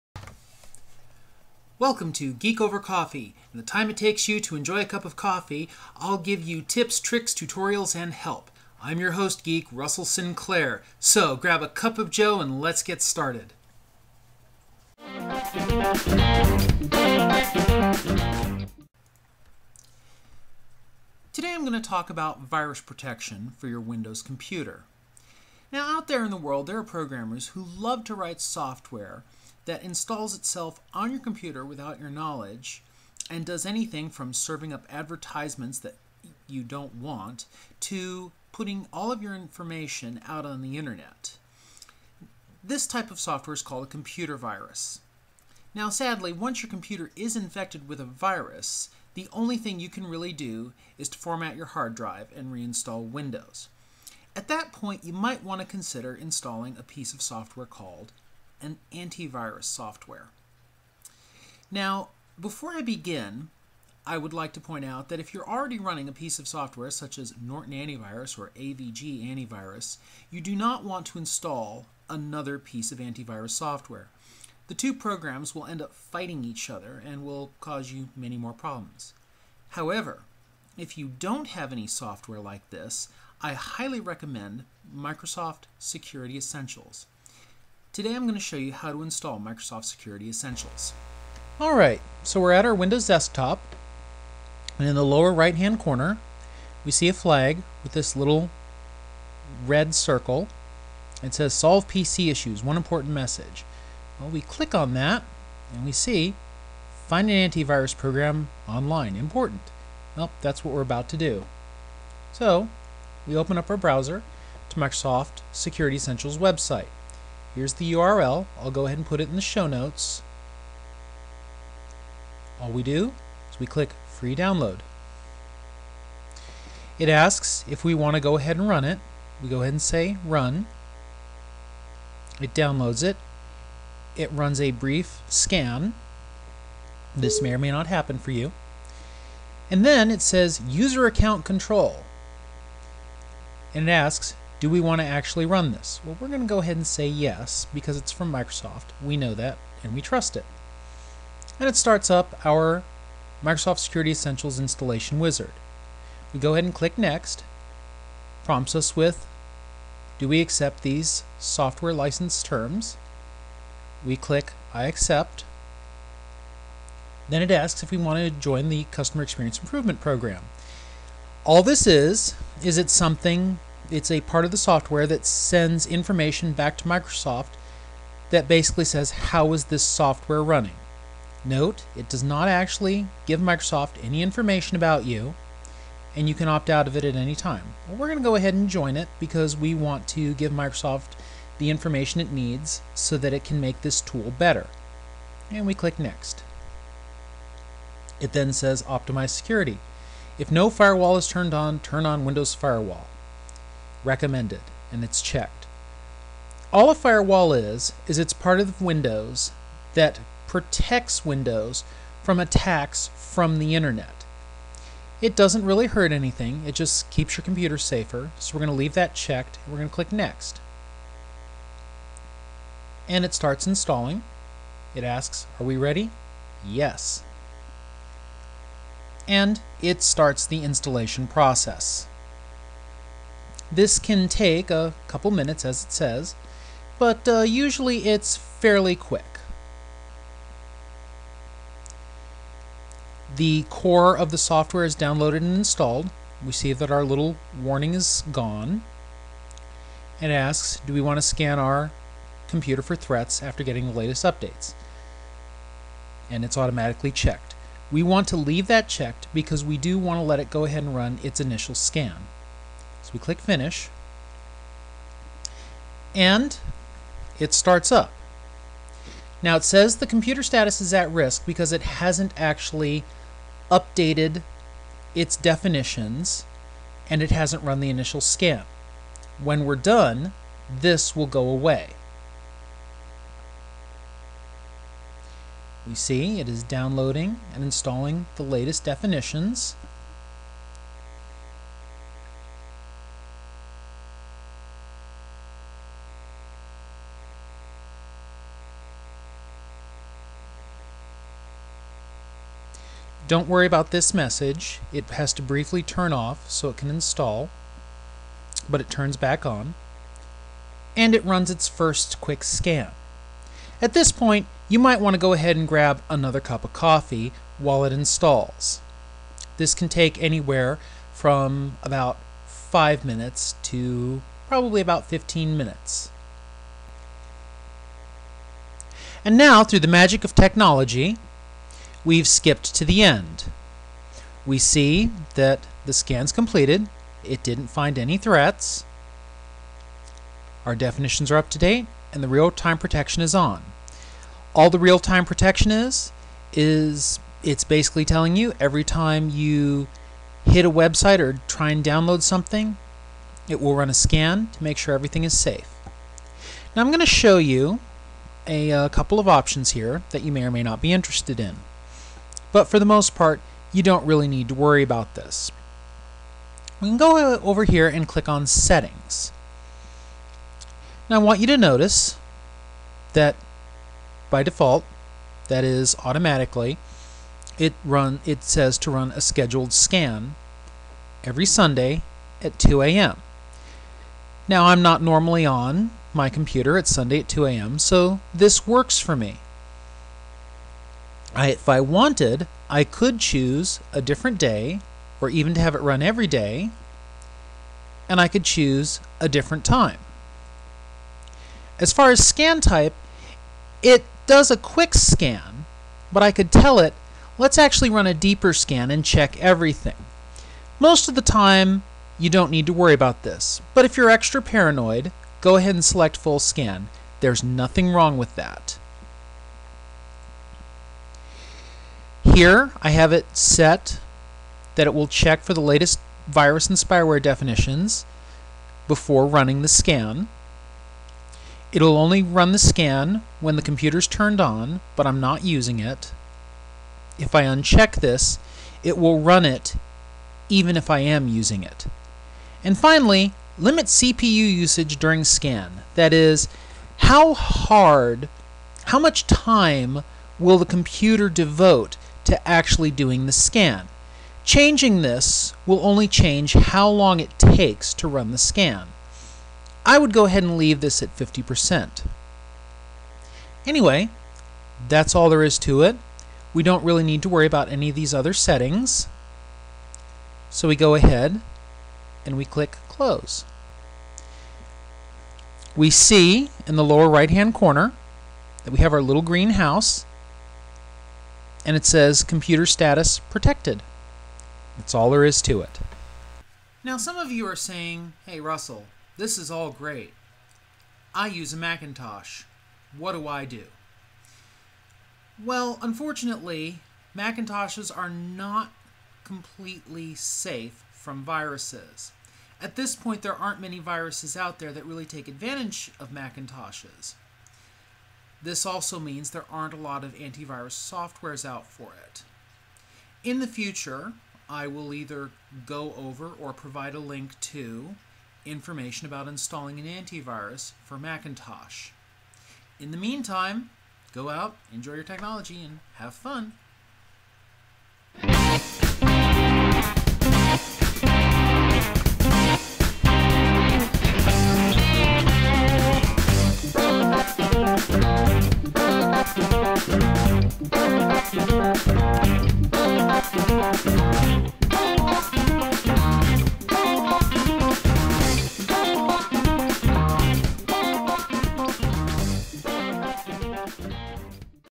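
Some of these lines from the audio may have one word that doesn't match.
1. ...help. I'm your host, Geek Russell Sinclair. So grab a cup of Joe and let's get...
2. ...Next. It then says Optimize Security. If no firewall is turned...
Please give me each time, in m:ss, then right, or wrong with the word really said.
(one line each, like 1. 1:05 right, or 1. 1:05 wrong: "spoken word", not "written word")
1. 0:08 right
2. 3:15 right.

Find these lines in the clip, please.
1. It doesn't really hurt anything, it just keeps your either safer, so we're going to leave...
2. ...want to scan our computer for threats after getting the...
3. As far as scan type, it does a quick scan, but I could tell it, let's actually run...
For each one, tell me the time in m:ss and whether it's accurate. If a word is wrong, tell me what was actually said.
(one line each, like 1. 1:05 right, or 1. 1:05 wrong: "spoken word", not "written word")
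1. 3:35 wrong: "computer", not "either"
2. 4:10 right
3. 6:41 right.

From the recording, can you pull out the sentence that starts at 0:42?
This type of software is called a computer virus.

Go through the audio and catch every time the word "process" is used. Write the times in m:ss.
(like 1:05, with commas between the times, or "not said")
3:51.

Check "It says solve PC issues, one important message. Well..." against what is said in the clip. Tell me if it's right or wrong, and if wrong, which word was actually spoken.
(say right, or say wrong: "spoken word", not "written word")
right.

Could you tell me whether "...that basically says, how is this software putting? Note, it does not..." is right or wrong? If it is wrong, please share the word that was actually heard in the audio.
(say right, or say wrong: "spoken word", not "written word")
wrong: "running", not "putting".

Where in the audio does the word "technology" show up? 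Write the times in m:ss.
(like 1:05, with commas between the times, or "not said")
5:30, 8:45.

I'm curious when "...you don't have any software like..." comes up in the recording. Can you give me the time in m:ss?
1:20.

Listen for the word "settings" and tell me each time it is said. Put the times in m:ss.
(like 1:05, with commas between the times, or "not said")
6:08, 7:48.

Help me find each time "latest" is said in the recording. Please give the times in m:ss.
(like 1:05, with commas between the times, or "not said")
4:13, 4:48, 7:05.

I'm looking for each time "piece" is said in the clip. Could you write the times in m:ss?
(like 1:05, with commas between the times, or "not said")
0:56, 1:06, 1:12.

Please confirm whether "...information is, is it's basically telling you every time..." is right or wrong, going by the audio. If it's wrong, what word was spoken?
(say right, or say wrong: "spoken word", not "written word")
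wrong: "protection", not "information".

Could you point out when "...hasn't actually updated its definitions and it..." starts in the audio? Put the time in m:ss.
4:31.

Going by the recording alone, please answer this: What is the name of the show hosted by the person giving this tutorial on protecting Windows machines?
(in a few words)
Geek Over Coffee.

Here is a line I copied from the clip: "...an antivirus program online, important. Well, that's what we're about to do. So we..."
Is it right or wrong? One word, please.
right.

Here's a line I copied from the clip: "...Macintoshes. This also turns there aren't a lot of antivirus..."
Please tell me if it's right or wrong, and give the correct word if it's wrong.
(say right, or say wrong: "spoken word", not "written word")
wrong: "means", not "turns".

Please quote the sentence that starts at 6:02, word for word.
But for the most part, you don't really need to worry about this.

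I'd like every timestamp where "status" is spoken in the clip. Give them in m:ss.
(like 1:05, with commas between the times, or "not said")
4:30, 8:02.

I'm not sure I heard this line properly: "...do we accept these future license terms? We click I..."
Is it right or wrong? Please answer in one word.
wrong.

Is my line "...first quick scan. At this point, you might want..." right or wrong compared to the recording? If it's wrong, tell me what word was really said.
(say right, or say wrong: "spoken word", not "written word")
right.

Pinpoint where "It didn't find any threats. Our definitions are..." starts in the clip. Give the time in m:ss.
5:37.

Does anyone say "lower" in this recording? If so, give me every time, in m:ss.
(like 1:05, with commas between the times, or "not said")
1:35, 7:56.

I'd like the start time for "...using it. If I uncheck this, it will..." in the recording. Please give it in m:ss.
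7:15.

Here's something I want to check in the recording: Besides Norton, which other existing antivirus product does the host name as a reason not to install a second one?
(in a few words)
AVG Antivirus.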